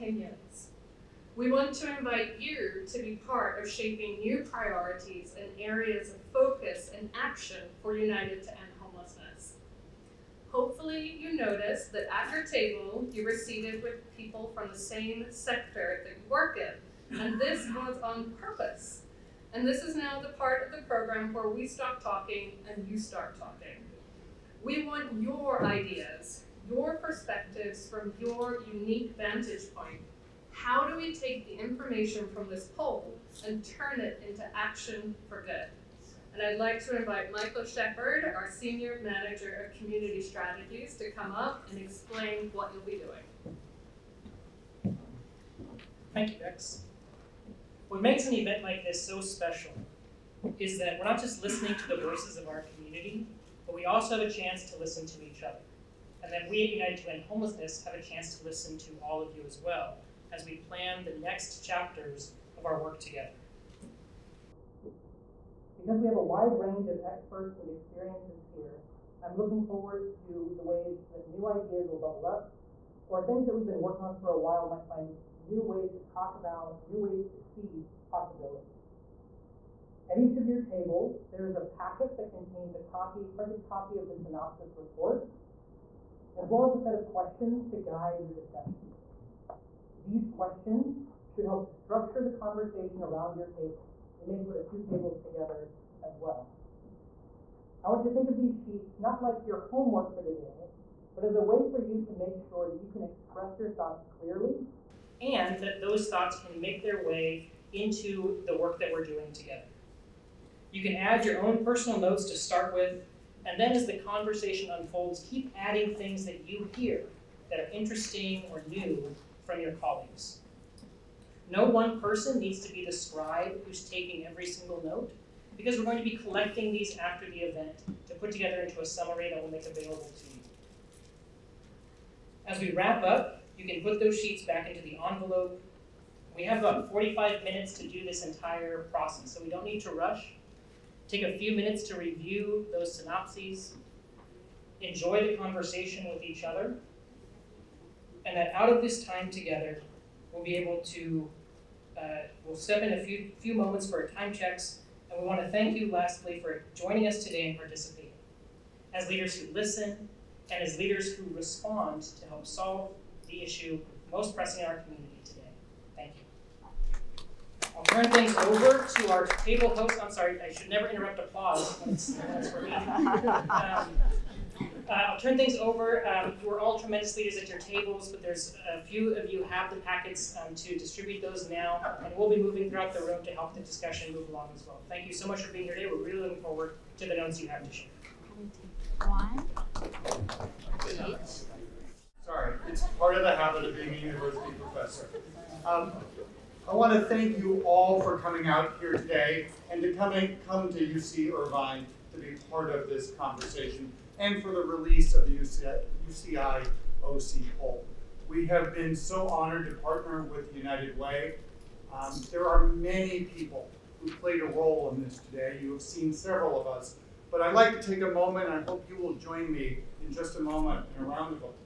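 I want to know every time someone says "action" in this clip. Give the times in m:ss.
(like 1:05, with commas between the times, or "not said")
0:07, 0:34.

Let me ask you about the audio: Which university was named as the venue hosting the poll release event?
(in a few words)
UC Irvine.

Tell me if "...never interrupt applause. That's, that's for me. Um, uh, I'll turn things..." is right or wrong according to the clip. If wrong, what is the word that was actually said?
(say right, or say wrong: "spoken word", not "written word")
right.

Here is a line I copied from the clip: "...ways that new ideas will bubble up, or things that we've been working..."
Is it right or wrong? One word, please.
right.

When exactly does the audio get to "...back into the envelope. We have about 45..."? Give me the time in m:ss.
2:14.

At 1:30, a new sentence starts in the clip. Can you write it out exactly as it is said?
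These questions should help to structure the conversation around your table.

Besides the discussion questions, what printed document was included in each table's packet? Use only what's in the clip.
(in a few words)
synopsis report.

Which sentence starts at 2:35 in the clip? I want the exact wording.
And we want to thank you lastly for joining us today and participating.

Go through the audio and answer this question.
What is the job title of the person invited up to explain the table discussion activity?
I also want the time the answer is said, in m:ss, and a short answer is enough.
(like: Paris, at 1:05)
Senior Manager of Community Strategies, at 0:38.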